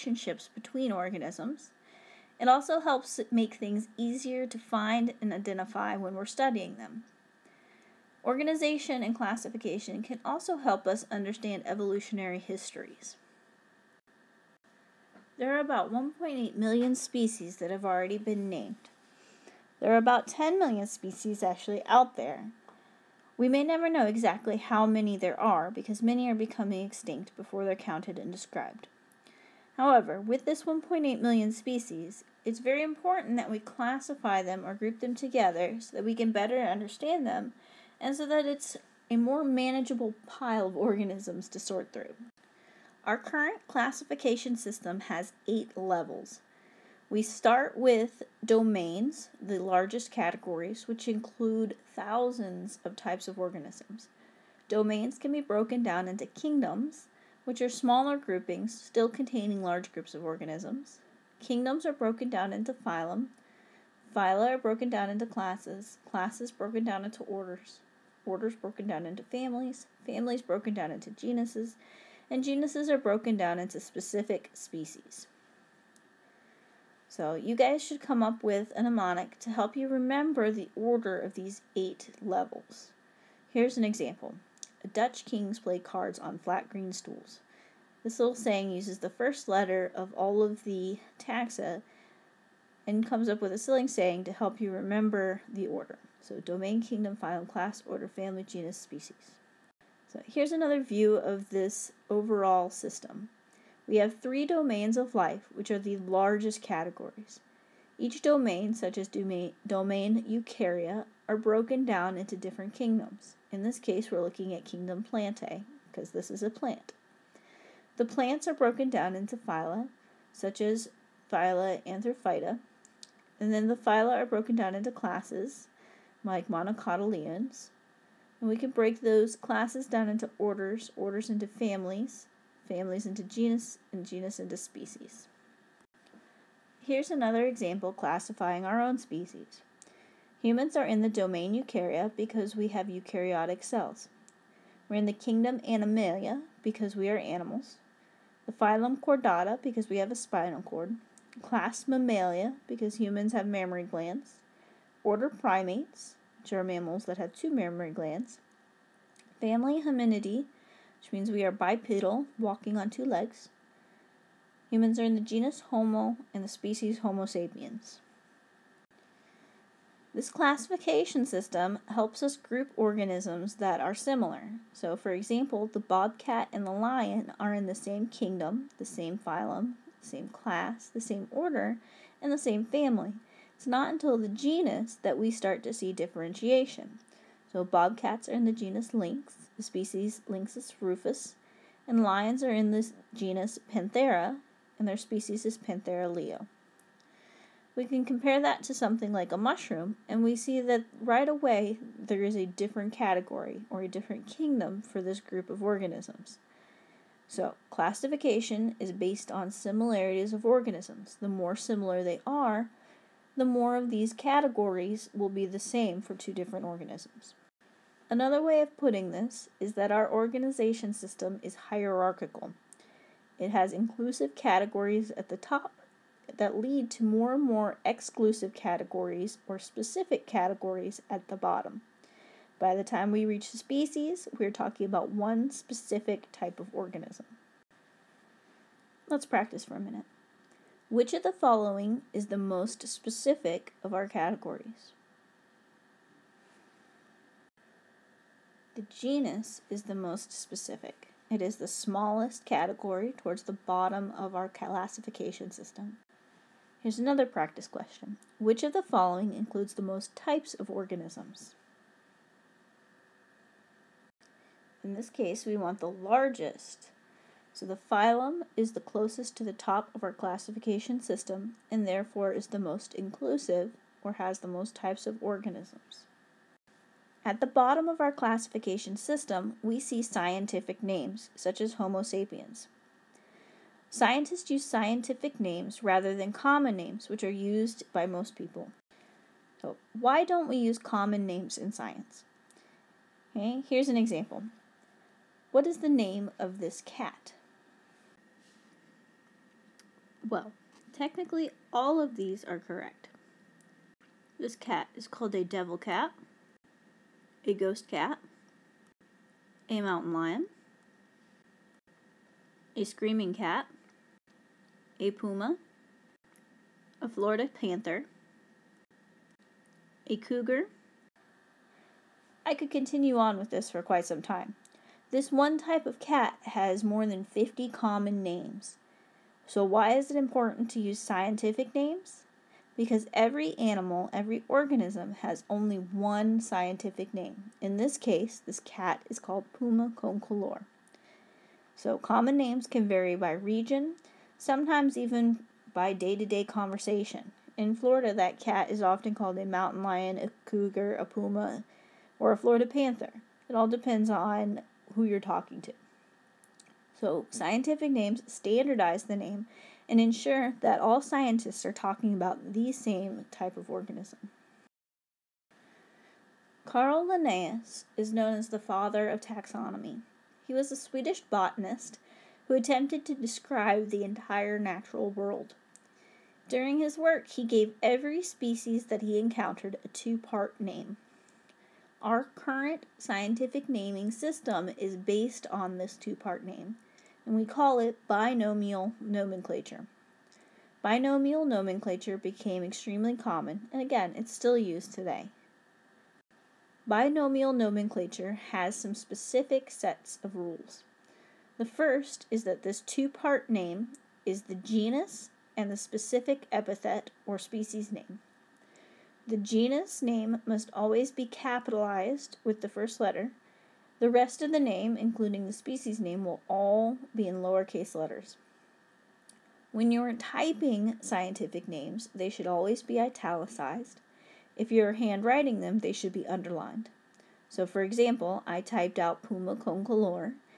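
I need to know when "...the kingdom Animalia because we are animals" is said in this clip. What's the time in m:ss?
2:25.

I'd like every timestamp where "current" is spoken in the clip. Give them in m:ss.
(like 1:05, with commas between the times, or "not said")
0:43, 6:22.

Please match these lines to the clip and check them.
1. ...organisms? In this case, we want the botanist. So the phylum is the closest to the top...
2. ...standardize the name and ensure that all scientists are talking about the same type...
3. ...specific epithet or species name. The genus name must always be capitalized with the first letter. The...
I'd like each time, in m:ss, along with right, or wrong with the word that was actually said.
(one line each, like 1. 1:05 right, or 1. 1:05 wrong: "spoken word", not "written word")
1. 4:20 wrong: "largest", not "botanist"
2. 5:58 right
3. 6:45 right.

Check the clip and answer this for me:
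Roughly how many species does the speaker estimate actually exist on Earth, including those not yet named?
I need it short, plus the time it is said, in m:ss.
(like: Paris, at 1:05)
10 million, at 0:20.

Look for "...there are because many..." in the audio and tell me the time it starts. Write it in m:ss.
0:25.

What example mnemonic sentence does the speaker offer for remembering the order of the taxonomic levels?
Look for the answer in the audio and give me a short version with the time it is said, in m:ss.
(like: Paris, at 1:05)
Dutch kings play cards on flat green stools, at 1:24.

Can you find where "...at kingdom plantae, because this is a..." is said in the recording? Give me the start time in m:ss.
1:54.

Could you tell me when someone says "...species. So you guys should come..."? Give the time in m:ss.
1:14.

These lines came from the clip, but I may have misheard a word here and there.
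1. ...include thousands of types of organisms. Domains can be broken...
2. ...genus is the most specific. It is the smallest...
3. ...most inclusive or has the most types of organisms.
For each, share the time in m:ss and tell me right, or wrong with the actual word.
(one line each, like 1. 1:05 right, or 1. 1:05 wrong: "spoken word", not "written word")
1. 0:51 right
2. 4:08 right
3. 4:32 right.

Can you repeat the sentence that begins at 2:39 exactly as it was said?
Family Hominidae which means we are bipedal, walking on two legs.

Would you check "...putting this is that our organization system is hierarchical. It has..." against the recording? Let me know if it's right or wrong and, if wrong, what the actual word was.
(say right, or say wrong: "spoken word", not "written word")
right.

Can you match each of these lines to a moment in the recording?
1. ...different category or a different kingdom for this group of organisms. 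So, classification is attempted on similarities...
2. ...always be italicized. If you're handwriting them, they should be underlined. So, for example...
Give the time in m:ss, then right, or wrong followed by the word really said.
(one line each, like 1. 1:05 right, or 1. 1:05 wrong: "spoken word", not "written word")
1. 3:22 wrong: "based", not "attempted"
2. 7:02 right.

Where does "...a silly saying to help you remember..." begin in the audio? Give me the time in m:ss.
1:33.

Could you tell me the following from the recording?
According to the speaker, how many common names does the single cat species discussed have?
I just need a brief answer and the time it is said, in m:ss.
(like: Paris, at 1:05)
more than 50, at 5:26.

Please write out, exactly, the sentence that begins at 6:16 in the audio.
During his work, he gave every species that he encountered a two part name.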